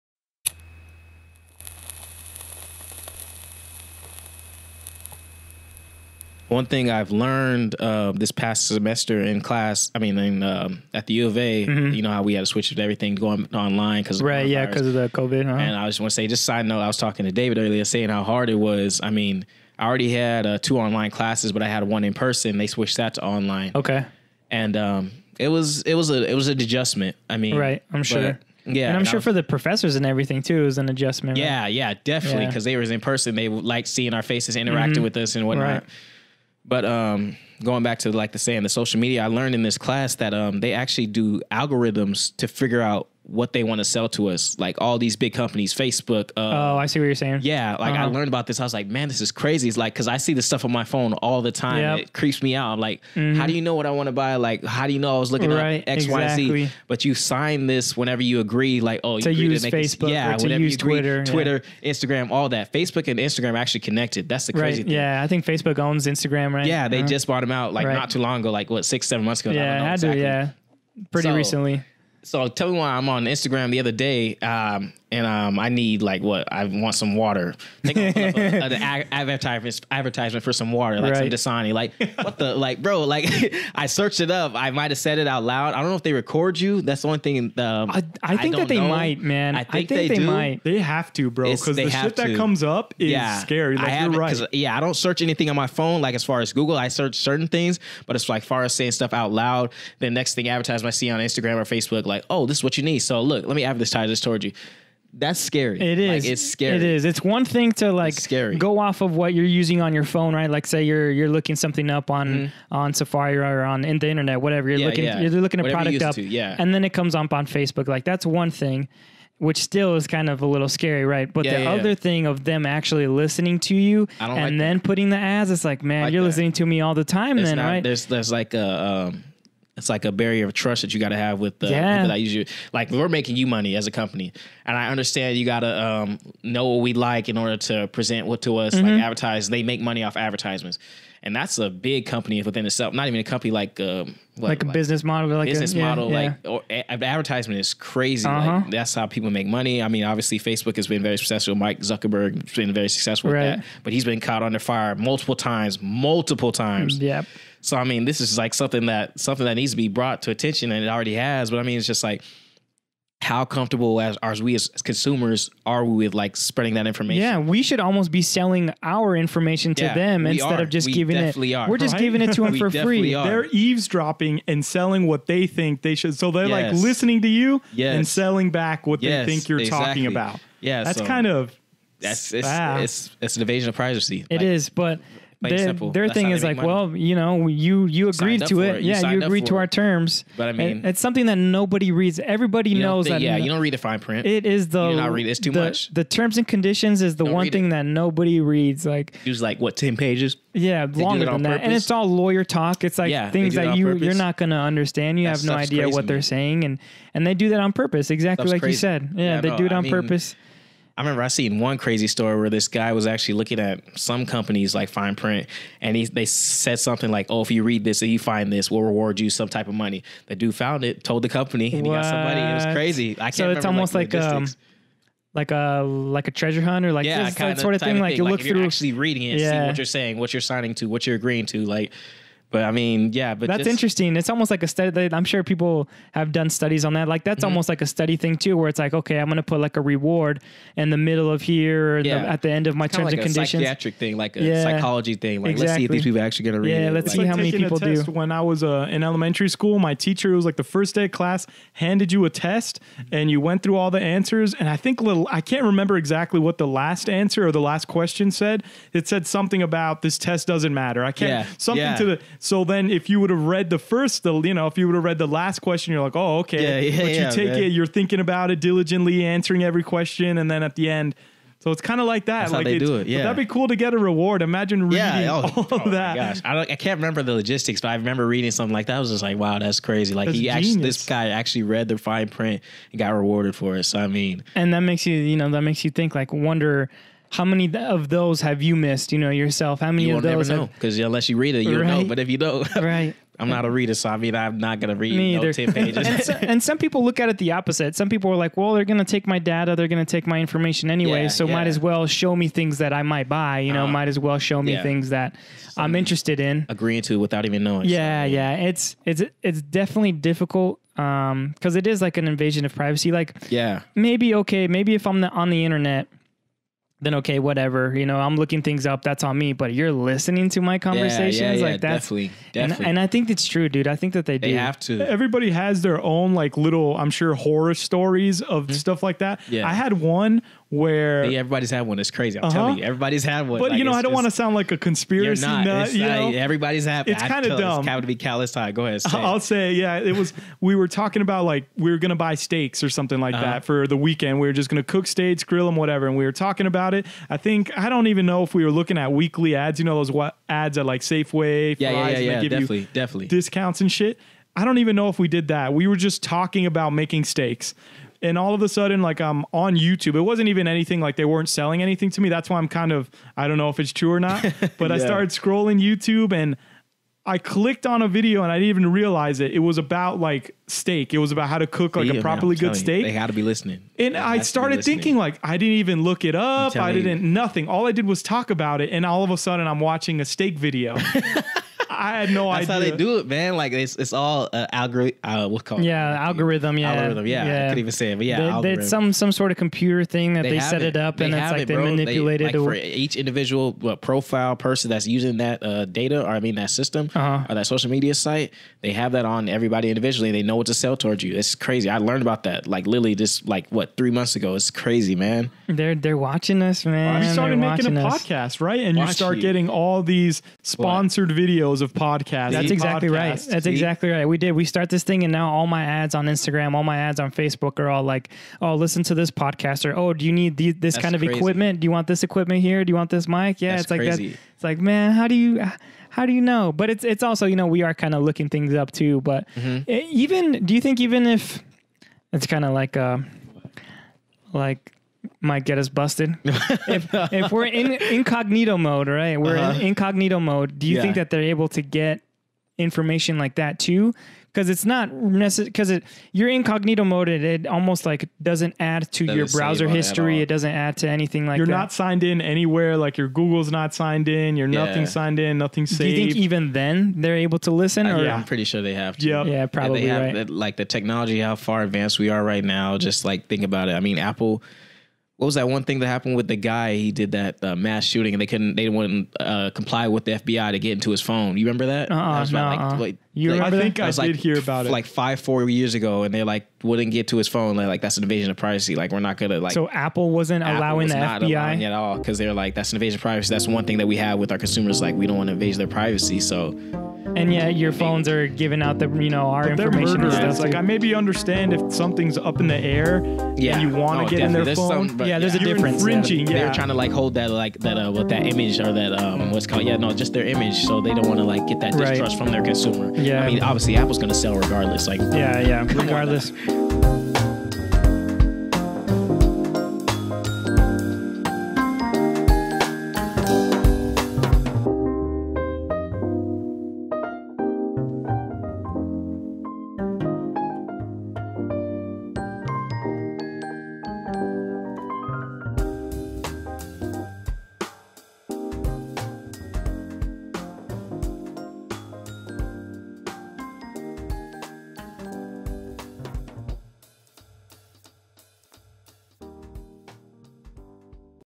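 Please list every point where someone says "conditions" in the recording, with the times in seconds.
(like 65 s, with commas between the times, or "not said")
196 s, 243 s.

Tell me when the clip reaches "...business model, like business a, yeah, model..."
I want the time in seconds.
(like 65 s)
144 s.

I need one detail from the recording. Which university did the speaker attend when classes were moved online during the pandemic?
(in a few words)
U of A.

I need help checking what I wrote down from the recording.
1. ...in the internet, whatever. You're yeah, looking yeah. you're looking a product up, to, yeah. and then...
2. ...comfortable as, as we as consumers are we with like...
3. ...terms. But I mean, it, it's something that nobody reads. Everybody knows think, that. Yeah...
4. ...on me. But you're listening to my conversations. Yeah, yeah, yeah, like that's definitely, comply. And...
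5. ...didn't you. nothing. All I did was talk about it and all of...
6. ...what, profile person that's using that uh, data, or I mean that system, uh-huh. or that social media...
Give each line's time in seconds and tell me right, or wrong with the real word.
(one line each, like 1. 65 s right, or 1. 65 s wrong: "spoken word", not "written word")
1. 113 s right
2. 163 s right
3. 189 s right
4. 319 s wrong: "definitely", not "comply"
5. 376 s right
6. 393 s right.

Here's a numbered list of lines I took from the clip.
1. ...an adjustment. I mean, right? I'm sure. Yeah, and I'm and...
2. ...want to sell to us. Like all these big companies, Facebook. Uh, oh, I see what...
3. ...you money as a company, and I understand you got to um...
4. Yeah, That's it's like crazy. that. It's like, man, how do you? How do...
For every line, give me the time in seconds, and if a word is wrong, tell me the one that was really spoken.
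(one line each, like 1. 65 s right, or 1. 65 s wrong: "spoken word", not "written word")
1. 26 s right
2. 43 s right
3. 133 s right
4. 423 s right.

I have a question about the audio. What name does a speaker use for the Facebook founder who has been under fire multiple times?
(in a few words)
Mike Zuckerberg.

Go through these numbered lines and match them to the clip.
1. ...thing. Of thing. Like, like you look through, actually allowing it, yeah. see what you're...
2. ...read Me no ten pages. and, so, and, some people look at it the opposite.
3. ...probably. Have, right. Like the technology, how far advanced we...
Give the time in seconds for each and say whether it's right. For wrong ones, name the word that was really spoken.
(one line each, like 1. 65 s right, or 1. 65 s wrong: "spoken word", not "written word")
1. 227 s wrong: "reading", not "allowing"
2. 294 s right
3. 459 s right.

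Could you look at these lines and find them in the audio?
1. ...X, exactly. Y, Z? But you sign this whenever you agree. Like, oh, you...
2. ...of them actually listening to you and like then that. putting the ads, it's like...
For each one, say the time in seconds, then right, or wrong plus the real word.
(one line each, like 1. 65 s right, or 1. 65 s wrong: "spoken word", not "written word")
1. 55 s right
2. 122 s right.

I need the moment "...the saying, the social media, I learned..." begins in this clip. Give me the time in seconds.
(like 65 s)
38 s.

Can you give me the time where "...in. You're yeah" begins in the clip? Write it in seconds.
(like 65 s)
454 s.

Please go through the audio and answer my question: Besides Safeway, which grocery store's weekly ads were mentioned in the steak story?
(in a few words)
Fry's.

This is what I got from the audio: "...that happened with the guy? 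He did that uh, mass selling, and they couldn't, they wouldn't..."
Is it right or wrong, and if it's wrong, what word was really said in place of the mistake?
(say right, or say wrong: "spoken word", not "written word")
wrong: "shooting", not "selling".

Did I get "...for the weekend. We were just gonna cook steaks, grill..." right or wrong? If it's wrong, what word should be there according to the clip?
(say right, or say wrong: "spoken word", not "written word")
right.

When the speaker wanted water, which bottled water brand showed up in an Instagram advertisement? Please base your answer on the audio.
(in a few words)
Dasani.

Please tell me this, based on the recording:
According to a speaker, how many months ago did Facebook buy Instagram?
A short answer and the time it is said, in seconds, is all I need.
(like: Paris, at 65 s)
6 or 7, at 68 s.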